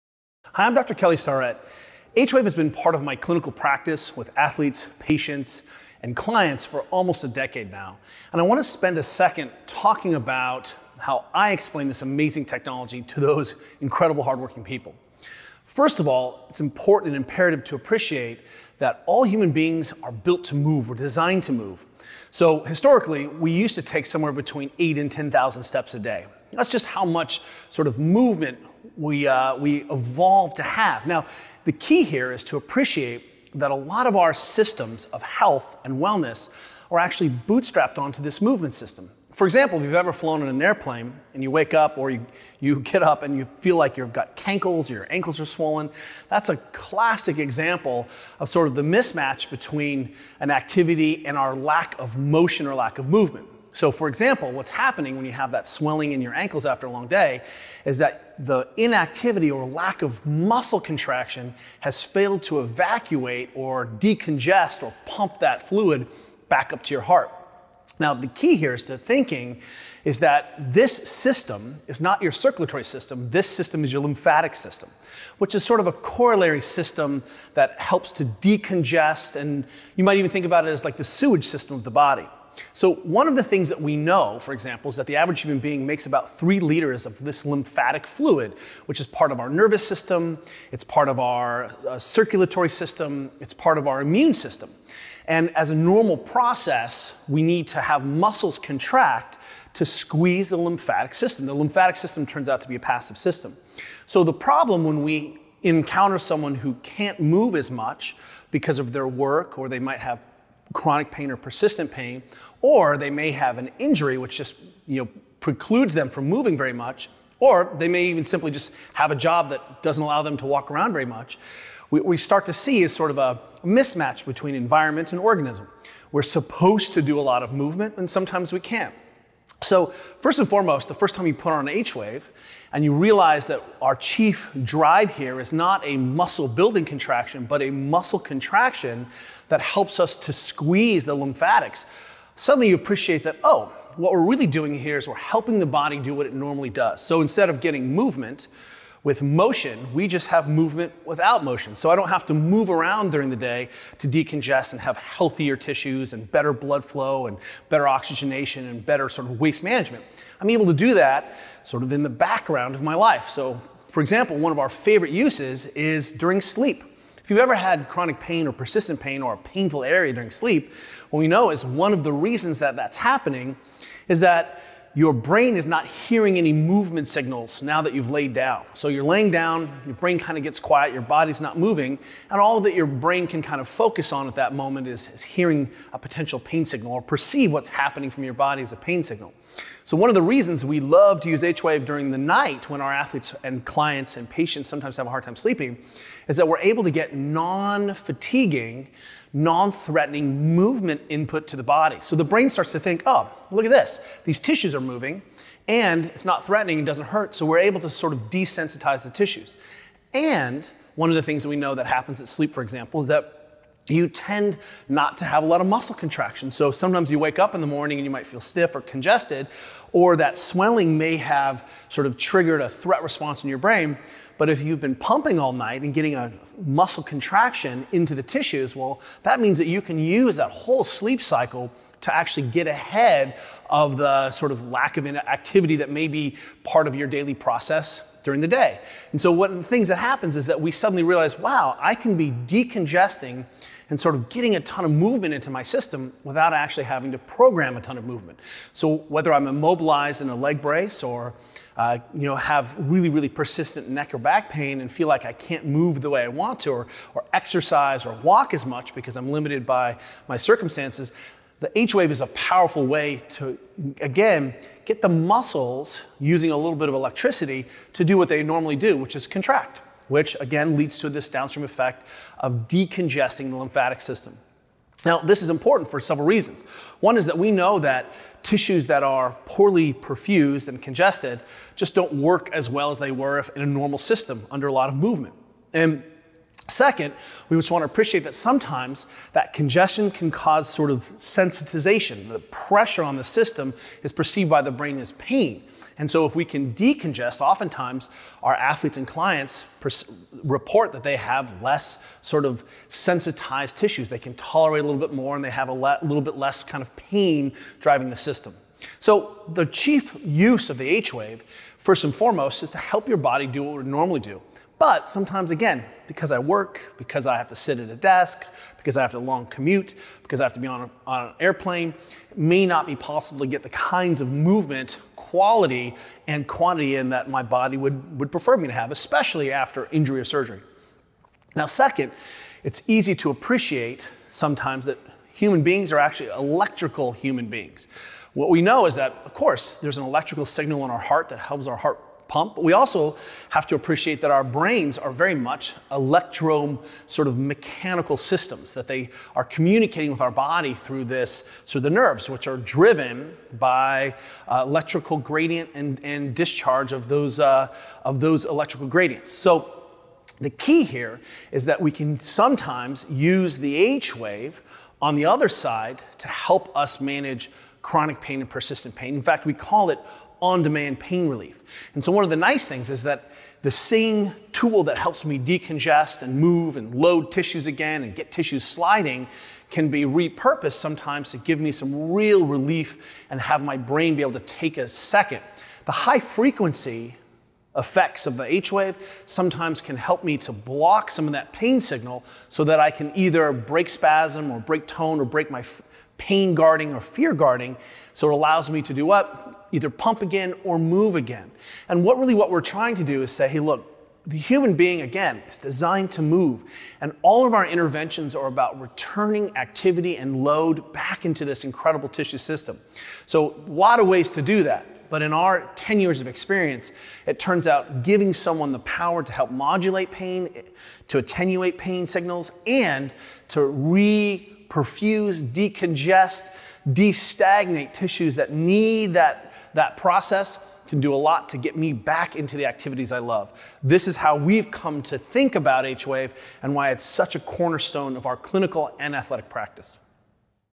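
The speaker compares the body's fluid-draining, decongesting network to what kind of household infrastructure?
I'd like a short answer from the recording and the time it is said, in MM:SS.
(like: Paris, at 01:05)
sewage system, at 01:21.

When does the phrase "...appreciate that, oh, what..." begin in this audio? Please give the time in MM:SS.
02:22.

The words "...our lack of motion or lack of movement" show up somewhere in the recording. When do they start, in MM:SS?
00:51.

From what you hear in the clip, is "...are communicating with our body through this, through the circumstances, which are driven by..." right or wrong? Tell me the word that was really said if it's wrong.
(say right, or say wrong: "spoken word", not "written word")
wrong: "nerves", not "circumstances".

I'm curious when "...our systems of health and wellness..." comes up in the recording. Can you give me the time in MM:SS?
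00:34.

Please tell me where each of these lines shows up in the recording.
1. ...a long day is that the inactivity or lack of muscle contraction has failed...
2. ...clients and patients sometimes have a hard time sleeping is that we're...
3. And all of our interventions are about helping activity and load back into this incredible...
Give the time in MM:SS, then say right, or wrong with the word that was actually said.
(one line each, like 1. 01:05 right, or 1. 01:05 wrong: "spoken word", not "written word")
1. 00:56 right
2. 03:13 right
3. 06:47 wrong: "returning", not "helping".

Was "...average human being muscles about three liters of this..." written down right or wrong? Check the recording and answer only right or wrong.
wrong.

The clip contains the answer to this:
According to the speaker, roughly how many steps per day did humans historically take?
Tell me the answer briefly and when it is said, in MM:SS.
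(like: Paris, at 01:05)
8 to 10,000, at 00:24.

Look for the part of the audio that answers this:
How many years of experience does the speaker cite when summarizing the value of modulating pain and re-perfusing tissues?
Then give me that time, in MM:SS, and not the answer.
06:55.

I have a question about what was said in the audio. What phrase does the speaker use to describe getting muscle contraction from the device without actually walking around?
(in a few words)
movement without motion.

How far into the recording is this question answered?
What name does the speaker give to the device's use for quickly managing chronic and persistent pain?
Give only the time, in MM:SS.
06:10.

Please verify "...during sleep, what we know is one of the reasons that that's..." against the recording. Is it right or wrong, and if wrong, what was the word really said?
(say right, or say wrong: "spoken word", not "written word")
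right.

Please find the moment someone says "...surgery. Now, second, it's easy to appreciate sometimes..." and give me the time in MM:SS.
05:30.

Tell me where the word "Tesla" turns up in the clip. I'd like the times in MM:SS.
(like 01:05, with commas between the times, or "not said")
not said.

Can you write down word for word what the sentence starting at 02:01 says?
What we start to see is sort of a mismatch between environment and organism.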